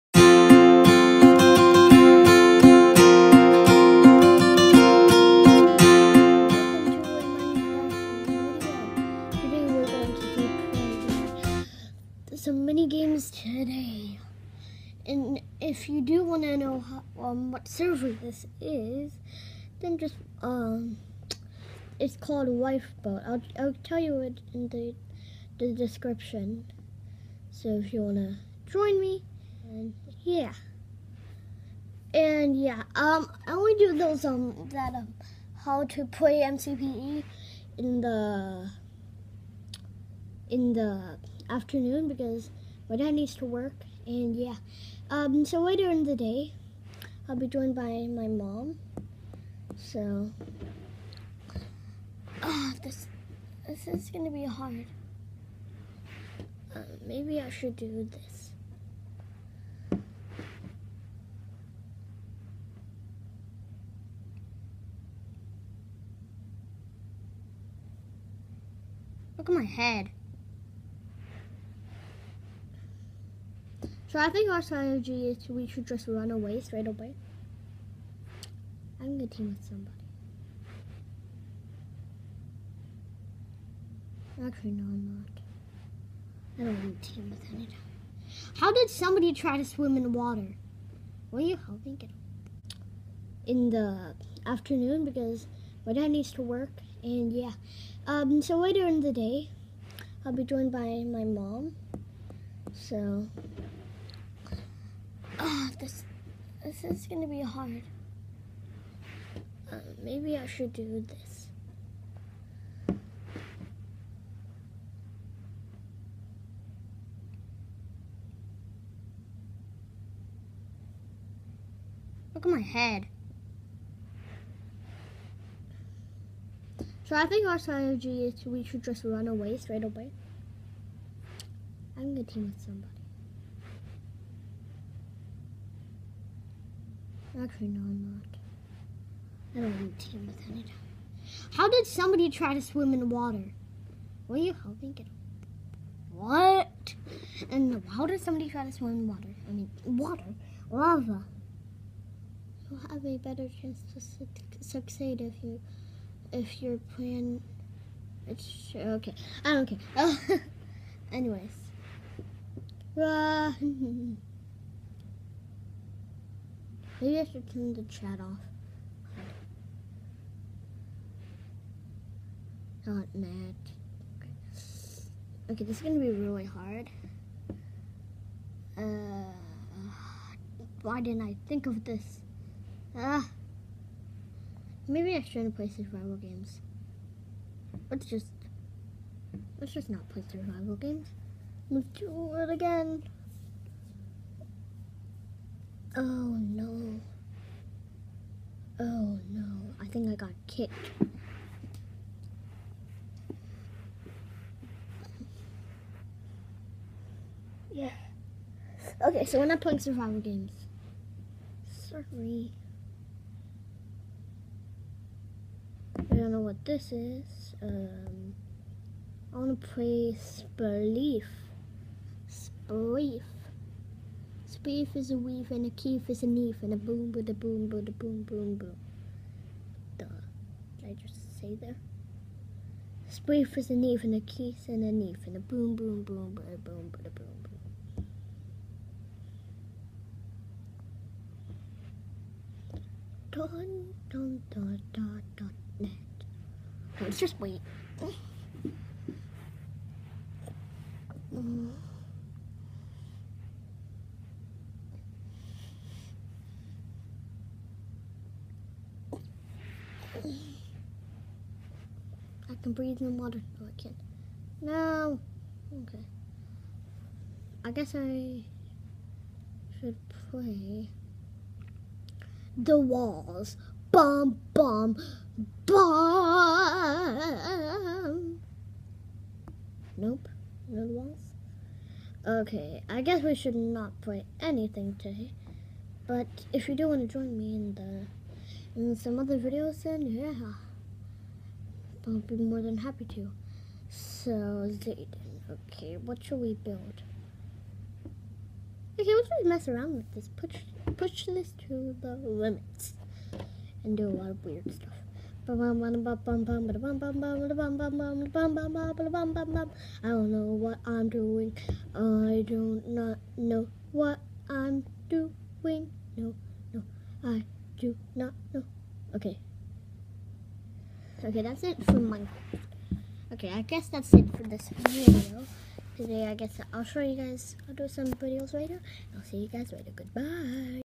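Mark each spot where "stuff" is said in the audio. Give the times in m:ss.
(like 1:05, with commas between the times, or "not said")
5:04.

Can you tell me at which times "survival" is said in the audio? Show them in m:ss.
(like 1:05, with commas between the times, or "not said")
3:05, 3:10, 3:29.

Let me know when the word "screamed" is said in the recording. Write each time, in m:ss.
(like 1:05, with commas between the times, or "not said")
not said.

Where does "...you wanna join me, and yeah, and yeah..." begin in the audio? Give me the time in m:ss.
0:27.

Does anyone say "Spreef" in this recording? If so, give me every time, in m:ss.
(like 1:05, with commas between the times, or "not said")
3:53.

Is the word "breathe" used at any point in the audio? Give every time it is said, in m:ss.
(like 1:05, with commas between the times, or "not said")
4:22.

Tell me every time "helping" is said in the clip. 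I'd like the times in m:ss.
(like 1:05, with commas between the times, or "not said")
1:31, 2:24.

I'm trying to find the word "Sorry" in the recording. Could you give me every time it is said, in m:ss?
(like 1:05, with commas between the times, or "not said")
3:31.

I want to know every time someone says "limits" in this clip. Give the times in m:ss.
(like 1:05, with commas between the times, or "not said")
5:02.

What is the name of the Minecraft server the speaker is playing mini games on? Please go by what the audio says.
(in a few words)
Lifeboat.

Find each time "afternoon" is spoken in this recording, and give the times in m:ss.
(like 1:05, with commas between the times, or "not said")
0:41, 1:34.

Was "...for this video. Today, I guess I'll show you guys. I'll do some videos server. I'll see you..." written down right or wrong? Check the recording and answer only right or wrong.
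wrong.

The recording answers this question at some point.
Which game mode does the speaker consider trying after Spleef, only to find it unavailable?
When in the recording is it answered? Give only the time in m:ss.
4:32.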